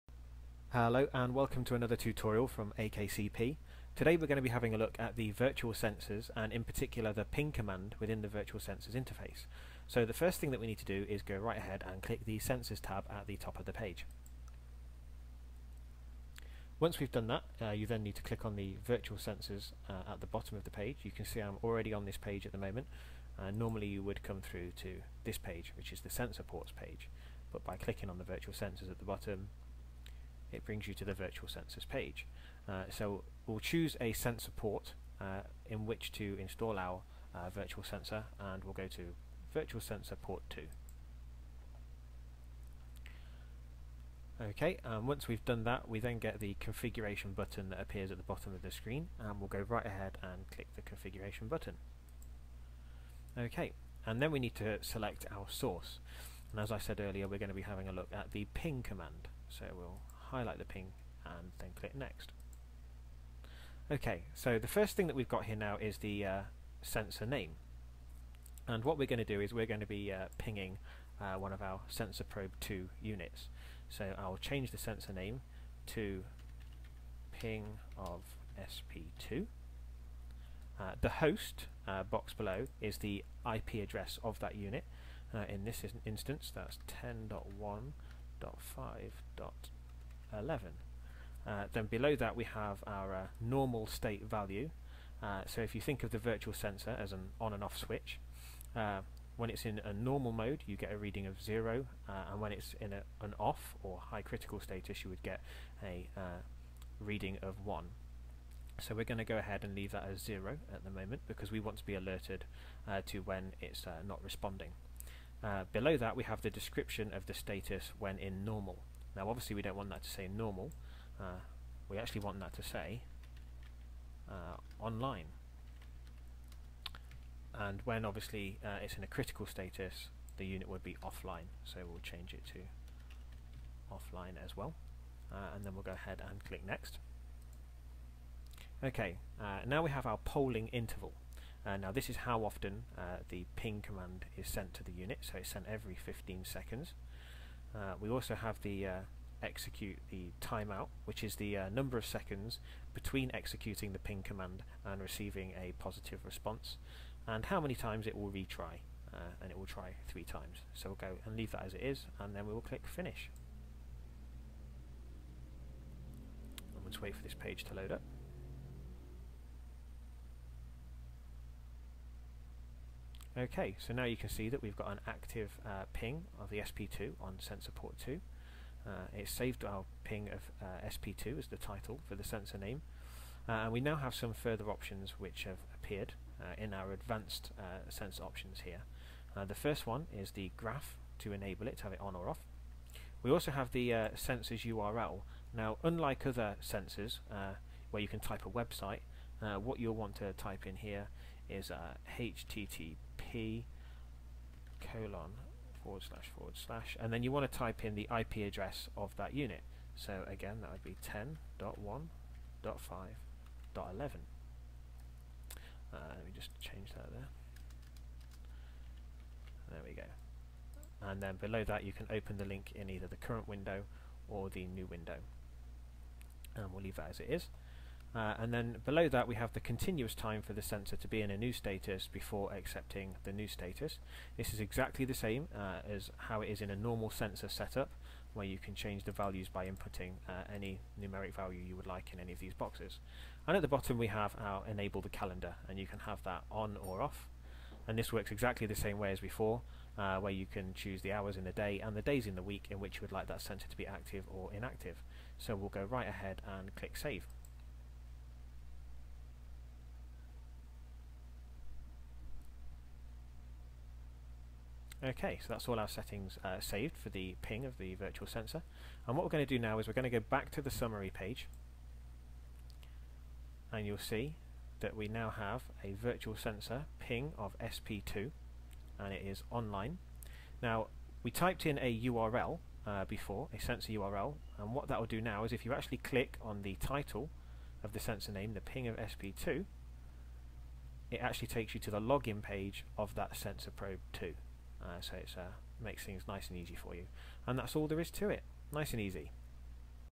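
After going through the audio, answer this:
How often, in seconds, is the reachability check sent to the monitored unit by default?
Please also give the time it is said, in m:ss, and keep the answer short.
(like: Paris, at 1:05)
15, at 2:25.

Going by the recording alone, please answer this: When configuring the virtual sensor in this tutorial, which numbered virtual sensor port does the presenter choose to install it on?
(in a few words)
2.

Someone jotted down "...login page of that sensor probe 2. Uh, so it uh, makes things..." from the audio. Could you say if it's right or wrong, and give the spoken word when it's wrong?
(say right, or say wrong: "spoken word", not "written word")
right.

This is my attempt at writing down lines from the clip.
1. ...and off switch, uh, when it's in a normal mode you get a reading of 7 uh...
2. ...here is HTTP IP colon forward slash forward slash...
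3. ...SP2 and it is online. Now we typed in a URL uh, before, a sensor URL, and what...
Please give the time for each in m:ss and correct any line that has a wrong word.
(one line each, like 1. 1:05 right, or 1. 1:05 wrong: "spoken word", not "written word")
1. 1:37 wrong: "0", not "7"
2. 3:20 right
3. 4:37 right.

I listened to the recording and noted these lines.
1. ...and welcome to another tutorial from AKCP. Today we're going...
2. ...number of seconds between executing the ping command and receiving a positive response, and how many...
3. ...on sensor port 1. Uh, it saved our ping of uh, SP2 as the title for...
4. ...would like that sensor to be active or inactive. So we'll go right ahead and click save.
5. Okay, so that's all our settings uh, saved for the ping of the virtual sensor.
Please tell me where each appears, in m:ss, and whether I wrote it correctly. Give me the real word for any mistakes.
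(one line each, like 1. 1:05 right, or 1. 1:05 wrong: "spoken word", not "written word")
1. 0:01 right
2. 2:31 right
3. 2:57 wrong: "2", not "1"
4. 4:13 right
5. 4:25 right.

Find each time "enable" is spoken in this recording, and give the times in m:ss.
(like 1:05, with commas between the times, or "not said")
3:11, 4:04.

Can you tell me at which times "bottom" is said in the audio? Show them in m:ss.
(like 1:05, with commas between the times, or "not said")
0:20, 0:29, 0:48, 4:03.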